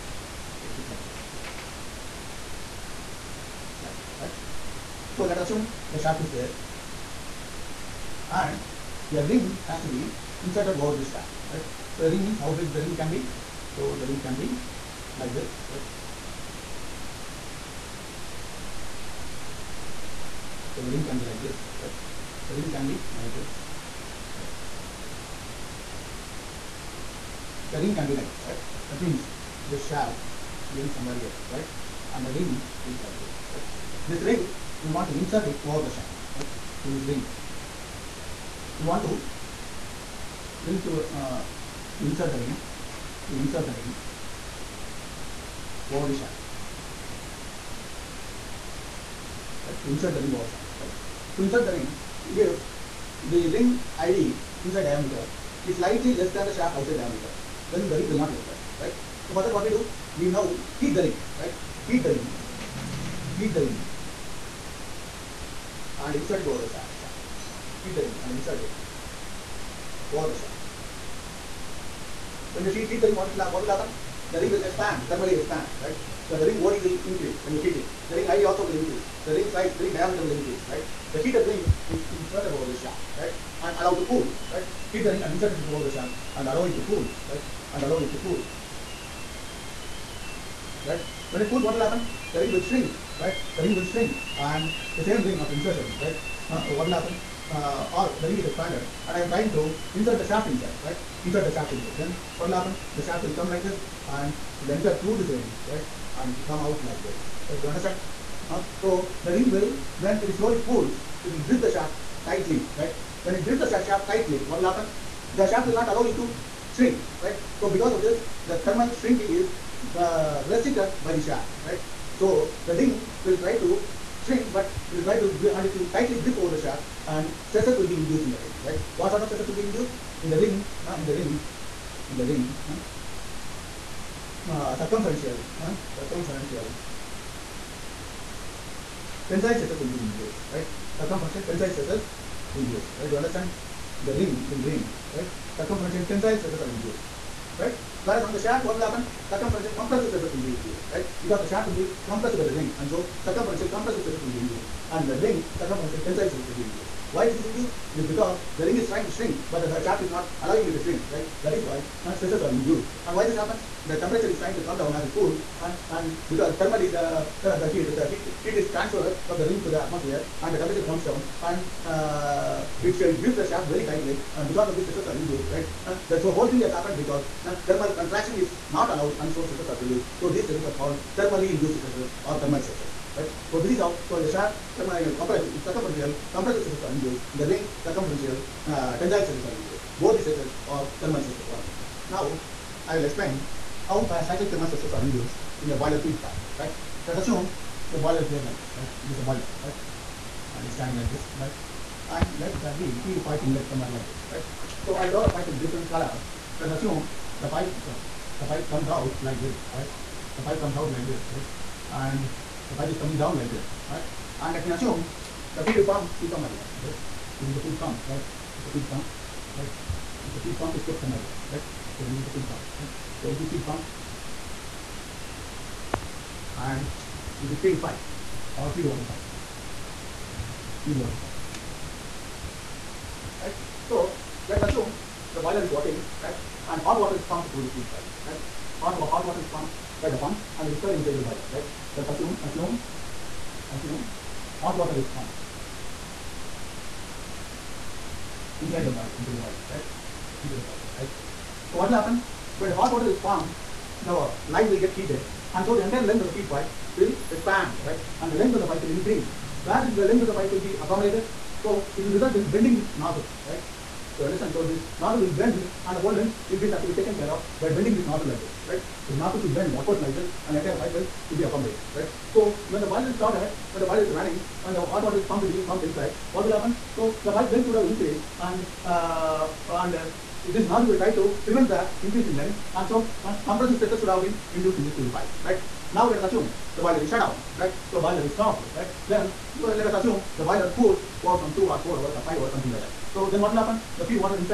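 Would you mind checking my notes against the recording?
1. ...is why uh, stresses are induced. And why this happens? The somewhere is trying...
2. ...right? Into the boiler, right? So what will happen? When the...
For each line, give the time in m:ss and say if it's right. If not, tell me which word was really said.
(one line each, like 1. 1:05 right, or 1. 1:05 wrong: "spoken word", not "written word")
1. 2:41 wrong: "temperature", not "somewhere"
2. 4:09 right.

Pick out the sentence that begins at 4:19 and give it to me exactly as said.
Where this length of the pipe will be accommodated, so it will result in bending this nozzle, right?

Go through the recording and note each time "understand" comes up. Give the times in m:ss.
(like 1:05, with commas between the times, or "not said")
1:47, 2:23, 4:24.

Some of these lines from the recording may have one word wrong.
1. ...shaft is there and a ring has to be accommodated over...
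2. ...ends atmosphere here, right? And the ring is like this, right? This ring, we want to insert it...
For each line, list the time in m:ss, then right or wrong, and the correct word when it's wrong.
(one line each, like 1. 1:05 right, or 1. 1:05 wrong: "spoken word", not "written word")
1. 0:05 wrong: "inserted", not "accommodated"
2. 0:30 wrong: "somewhere", not "atmosphere".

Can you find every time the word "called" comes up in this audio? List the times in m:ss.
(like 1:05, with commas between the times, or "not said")
3:00.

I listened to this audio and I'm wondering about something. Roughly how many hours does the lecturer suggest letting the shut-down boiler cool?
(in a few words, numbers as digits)
2 or 4 hours.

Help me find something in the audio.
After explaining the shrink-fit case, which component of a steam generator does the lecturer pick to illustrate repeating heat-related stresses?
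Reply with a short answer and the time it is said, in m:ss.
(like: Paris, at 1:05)
boiler feed pipe, at 3:15.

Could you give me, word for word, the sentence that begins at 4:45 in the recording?
Now let us assume the boiler is shut down, right?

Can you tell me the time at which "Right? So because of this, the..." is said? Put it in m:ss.
1:57.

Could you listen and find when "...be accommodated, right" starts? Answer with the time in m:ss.
4:31.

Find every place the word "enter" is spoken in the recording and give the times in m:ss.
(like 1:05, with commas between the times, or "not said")
0:58, 1:44.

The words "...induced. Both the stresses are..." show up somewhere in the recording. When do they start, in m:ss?
3:09.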